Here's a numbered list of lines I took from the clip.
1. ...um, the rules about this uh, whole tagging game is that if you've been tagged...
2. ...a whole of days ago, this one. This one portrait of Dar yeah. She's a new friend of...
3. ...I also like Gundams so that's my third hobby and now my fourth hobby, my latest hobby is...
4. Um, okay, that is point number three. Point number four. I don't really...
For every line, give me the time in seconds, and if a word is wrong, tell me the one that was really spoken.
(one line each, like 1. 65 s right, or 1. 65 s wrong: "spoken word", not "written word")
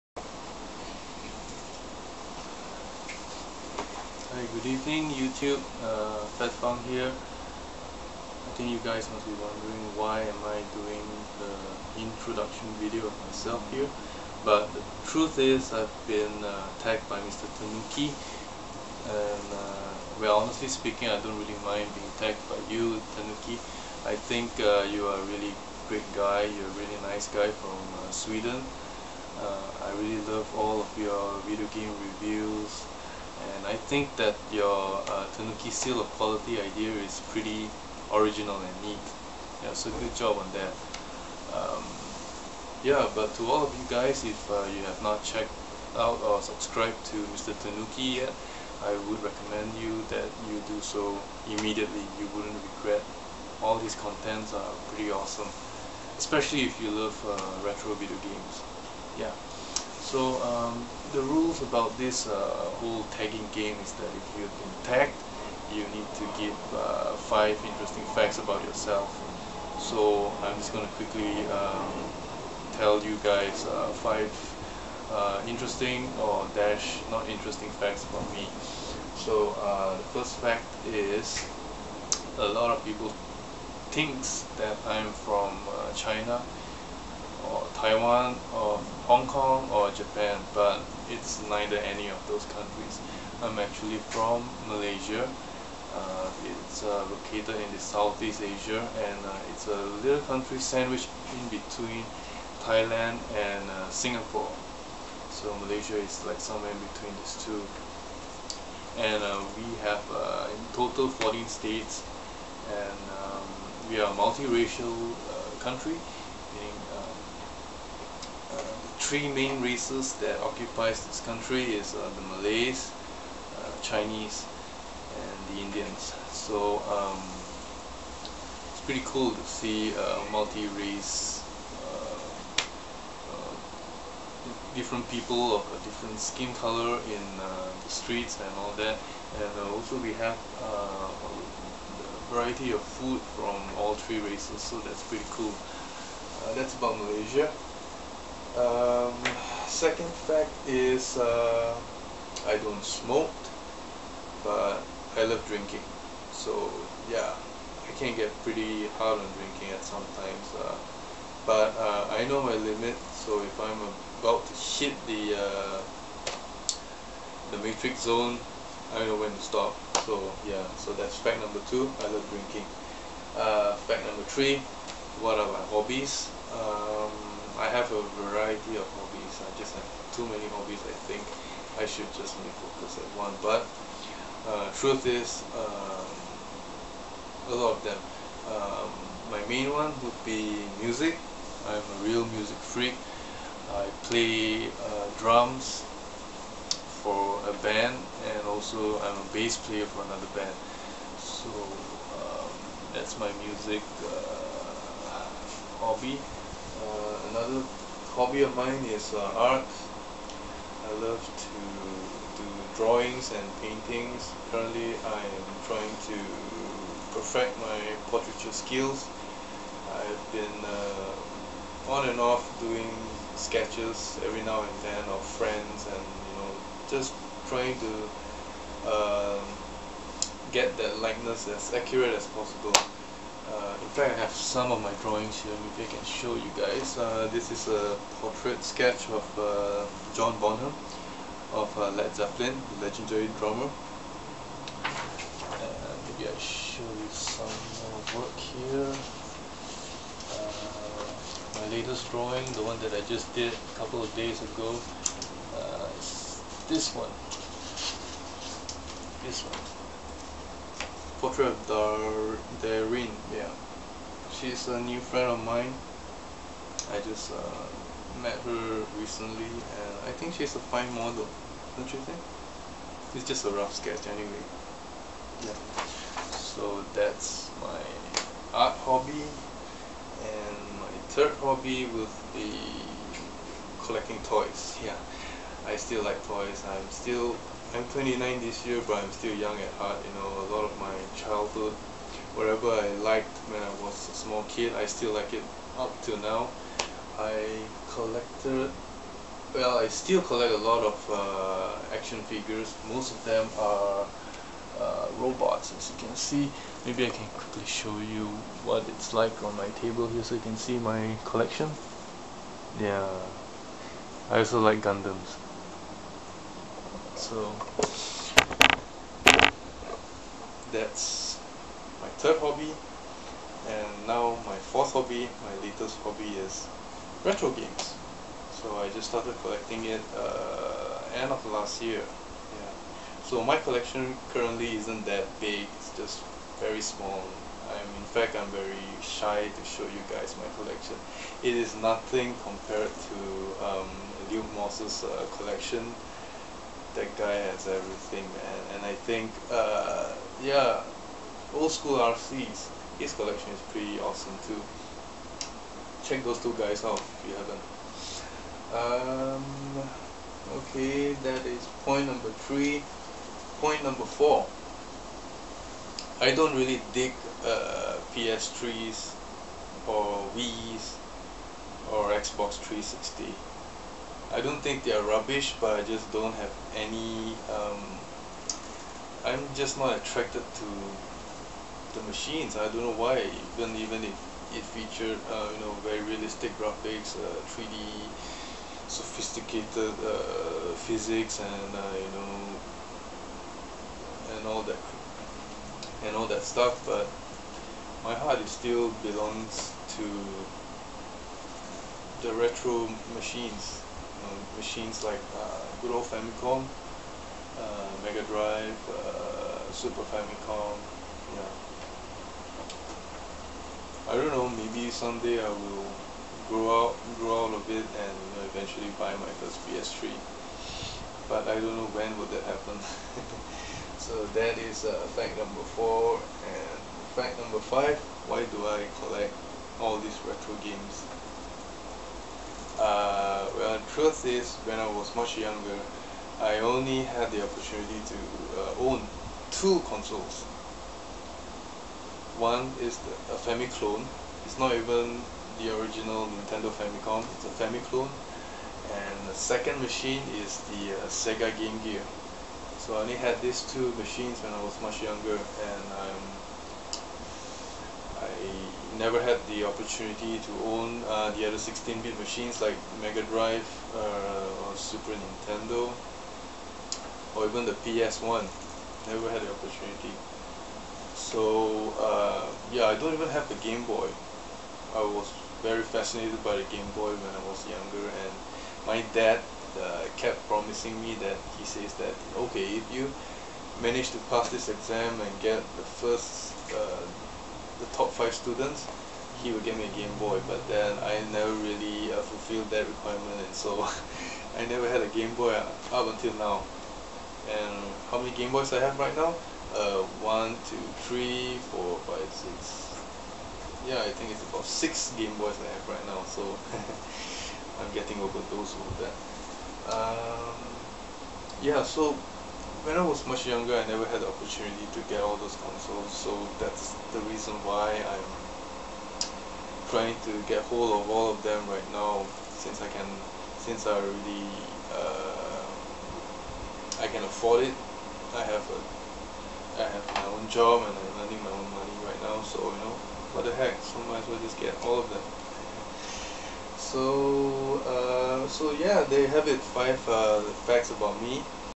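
1. 60 s right
2. 253 s wrong: "couple", not "whole"
3. 314 s right
4. 358 s right.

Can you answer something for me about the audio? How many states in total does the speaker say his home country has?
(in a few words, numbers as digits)
14.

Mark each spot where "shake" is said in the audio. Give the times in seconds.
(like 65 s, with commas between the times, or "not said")
not said.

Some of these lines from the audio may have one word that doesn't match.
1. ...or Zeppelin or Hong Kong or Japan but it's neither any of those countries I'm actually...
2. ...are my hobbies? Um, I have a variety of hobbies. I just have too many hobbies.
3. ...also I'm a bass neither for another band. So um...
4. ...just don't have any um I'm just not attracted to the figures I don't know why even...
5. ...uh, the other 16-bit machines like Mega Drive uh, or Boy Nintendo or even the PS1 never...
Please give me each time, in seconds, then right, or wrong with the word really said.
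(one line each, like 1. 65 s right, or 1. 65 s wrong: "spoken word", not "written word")
1. 87 s wrong: "Taiwan", not "Zeppelin"
2. 175 s right
3. 198 s wrong: "player", not "neither"
4. 375 s wrong: "machines", not "figures"
5. 461 s wrong: "Super", not "Boy".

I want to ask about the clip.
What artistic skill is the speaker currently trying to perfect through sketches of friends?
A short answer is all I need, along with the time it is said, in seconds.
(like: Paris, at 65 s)
portraiture, at 218 s.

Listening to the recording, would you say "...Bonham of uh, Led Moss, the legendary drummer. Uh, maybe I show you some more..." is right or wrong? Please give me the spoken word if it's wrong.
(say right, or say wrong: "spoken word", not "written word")
wrong: "Zeppelin", not "Moss".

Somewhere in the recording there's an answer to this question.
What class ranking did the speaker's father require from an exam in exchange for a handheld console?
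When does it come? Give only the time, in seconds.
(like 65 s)
487 s.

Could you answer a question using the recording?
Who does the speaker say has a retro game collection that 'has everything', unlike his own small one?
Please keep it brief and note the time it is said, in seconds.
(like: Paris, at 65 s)
Luke Moss, at 344 s.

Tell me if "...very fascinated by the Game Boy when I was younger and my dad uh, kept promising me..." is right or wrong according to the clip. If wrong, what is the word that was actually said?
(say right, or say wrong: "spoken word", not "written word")
right.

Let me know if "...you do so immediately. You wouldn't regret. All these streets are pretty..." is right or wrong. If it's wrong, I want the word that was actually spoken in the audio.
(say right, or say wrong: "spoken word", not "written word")
wrong: "contents", not "streets".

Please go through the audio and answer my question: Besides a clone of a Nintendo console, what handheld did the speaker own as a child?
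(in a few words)
Sega Game Gear.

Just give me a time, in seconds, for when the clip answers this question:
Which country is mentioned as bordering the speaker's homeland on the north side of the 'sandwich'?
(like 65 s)
102 s.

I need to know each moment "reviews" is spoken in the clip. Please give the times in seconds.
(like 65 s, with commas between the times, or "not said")
32 s.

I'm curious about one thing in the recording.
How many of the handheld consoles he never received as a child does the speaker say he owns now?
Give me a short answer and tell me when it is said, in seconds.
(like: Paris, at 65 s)
6, at 504 s.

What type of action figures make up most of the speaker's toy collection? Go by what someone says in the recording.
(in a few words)
robots.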